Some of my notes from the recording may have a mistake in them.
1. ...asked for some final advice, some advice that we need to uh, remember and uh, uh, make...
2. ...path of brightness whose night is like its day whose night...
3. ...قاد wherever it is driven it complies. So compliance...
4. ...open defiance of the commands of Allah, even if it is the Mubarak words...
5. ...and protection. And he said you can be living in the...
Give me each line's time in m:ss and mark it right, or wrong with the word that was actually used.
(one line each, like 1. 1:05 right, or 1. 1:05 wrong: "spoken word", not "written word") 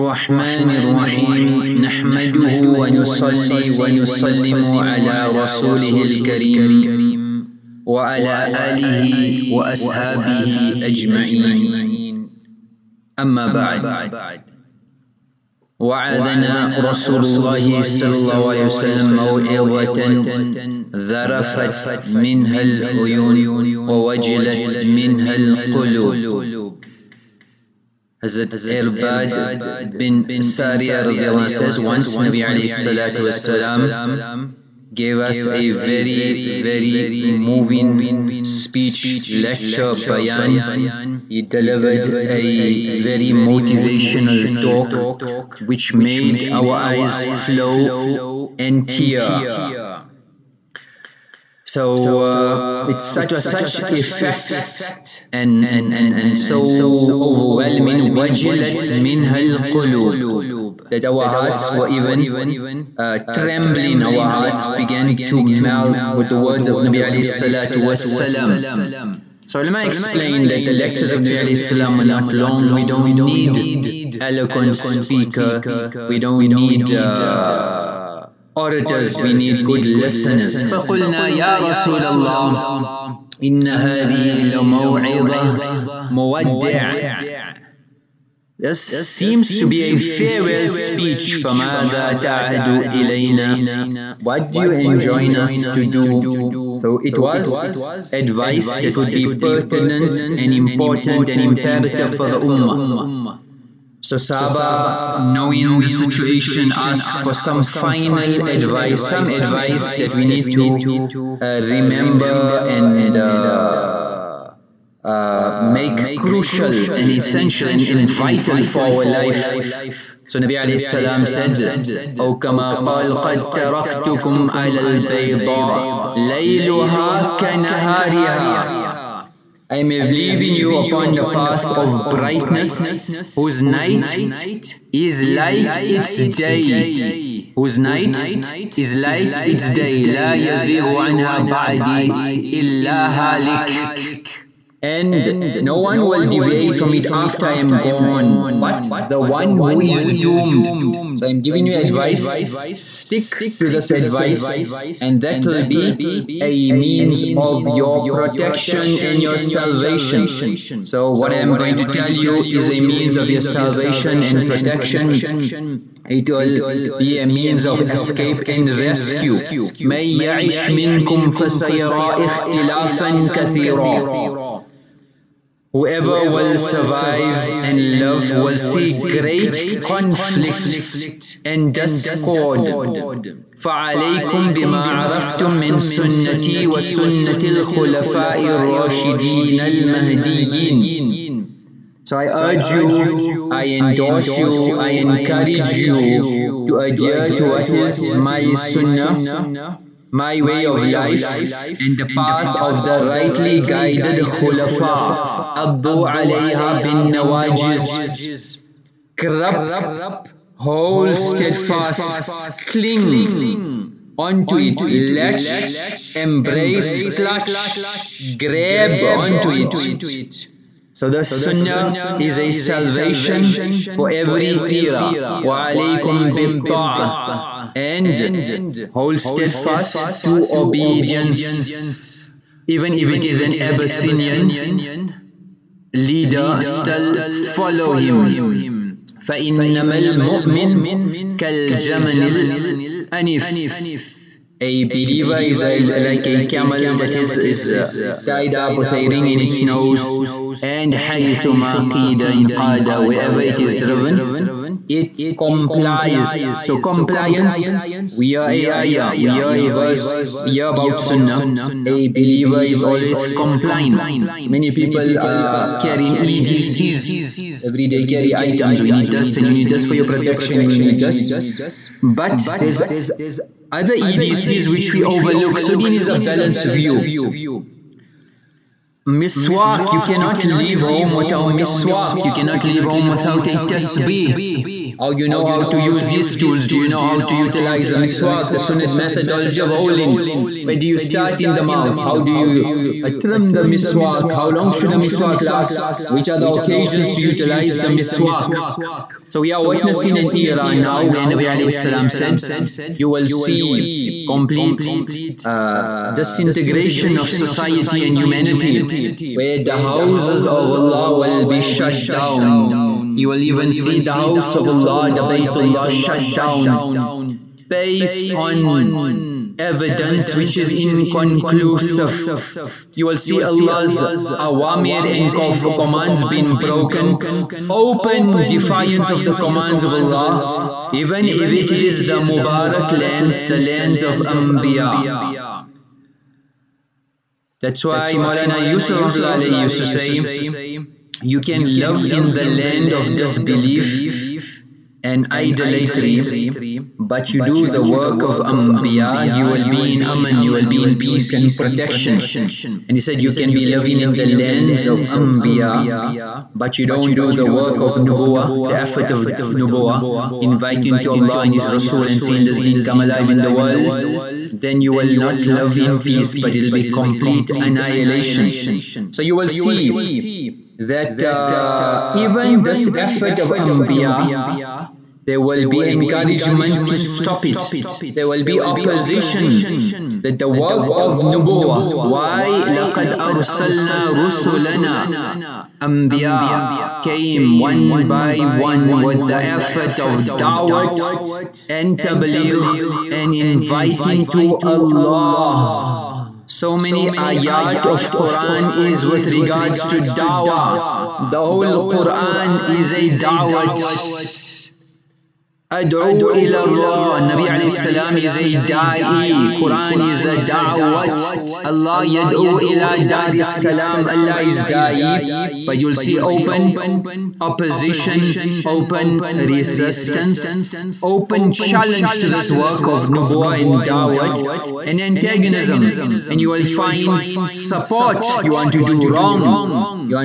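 1. 1:46 right
2. 2:11 right
3. 4:12 right
4. 5:27 wrong: "lands", not "words"
5. 5:51 right.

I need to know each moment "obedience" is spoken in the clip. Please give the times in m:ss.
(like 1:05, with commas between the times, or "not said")
3:50.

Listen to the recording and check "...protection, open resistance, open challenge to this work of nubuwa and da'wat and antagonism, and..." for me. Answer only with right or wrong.
wrong.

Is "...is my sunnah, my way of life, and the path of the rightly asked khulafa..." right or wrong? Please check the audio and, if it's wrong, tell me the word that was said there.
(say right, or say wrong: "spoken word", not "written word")
wrong: "guided", not "asked".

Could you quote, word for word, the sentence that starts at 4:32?
But there's other EDCs which we overlook.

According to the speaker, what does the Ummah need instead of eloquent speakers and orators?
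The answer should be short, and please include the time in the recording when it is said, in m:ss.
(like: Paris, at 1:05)
good listeners, at 1:19.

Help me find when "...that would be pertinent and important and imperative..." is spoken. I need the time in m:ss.
1:38.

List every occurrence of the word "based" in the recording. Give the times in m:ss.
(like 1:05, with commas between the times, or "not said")
5:17.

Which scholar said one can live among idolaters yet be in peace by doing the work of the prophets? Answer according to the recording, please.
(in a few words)
Maulana Yusuf.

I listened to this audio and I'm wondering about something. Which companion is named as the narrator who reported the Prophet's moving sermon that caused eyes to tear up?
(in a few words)
Irbad bin Sariya.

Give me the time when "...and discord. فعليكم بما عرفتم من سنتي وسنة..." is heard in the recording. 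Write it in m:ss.
3:01.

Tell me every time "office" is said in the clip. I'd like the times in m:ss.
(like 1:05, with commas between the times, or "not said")
not said.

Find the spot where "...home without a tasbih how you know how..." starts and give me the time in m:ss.
4:42.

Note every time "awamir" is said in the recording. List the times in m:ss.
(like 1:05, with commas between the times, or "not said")
5:24.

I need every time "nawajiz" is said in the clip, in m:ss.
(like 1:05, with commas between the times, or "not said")
3:27.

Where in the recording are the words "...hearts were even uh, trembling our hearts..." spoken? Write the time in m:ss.
1:01.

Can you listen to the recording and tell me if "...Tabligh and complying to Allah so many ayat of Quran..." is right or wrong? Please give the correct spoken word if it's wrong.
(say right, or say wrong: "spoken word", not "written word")
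wrong: "inviting", not "complying".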